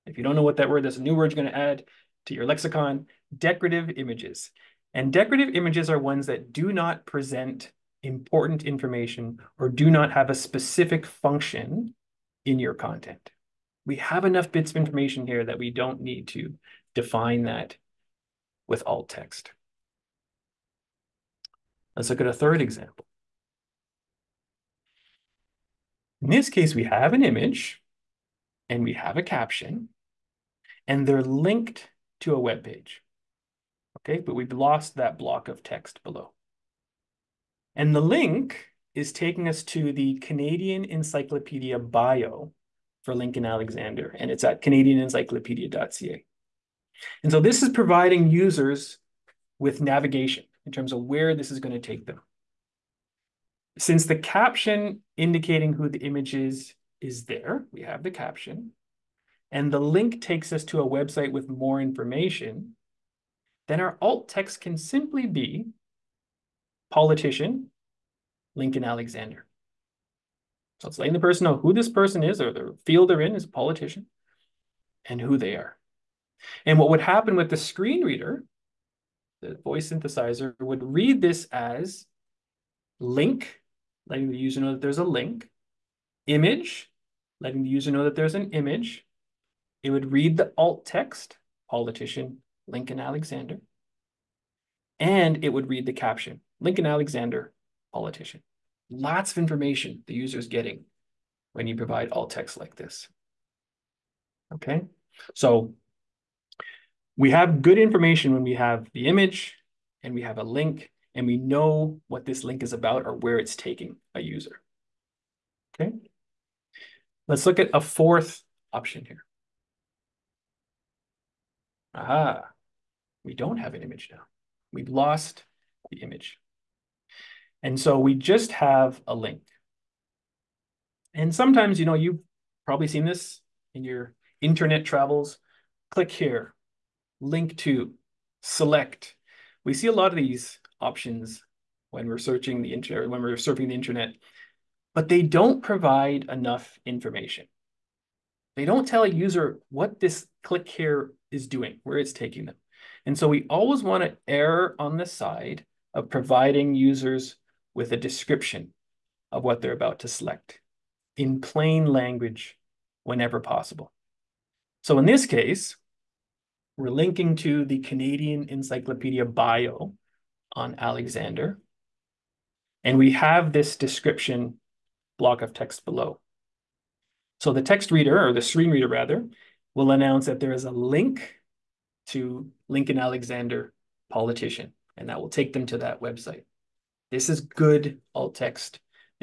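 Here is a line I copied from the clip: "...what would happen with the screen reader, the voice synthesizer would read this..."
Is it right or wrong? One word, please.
right.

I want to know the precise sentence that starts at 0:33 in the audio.
Okay, but we've lost that block of text below.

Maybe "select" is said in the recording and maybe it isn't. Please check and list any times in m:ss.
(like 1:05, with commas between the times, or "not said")
2:18, 2:40.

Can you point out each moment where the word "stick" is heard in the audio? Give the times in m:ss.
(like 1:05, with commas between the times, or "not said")
not said.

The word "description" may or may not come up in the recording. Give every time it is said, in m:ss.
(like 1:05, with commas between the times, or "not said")
2:37, 2:53.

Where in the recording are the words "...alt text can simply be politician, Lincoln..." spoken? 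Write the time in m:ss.
1:04.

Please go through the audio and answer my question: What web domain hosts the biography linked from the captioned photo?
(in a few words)
canadianencyclopedia.ca.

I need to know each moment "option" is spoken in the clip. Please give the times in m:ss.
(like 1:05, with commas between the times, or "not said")
1:58, 2:20.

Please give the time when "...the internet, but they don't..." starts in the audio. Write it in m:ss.
2:23.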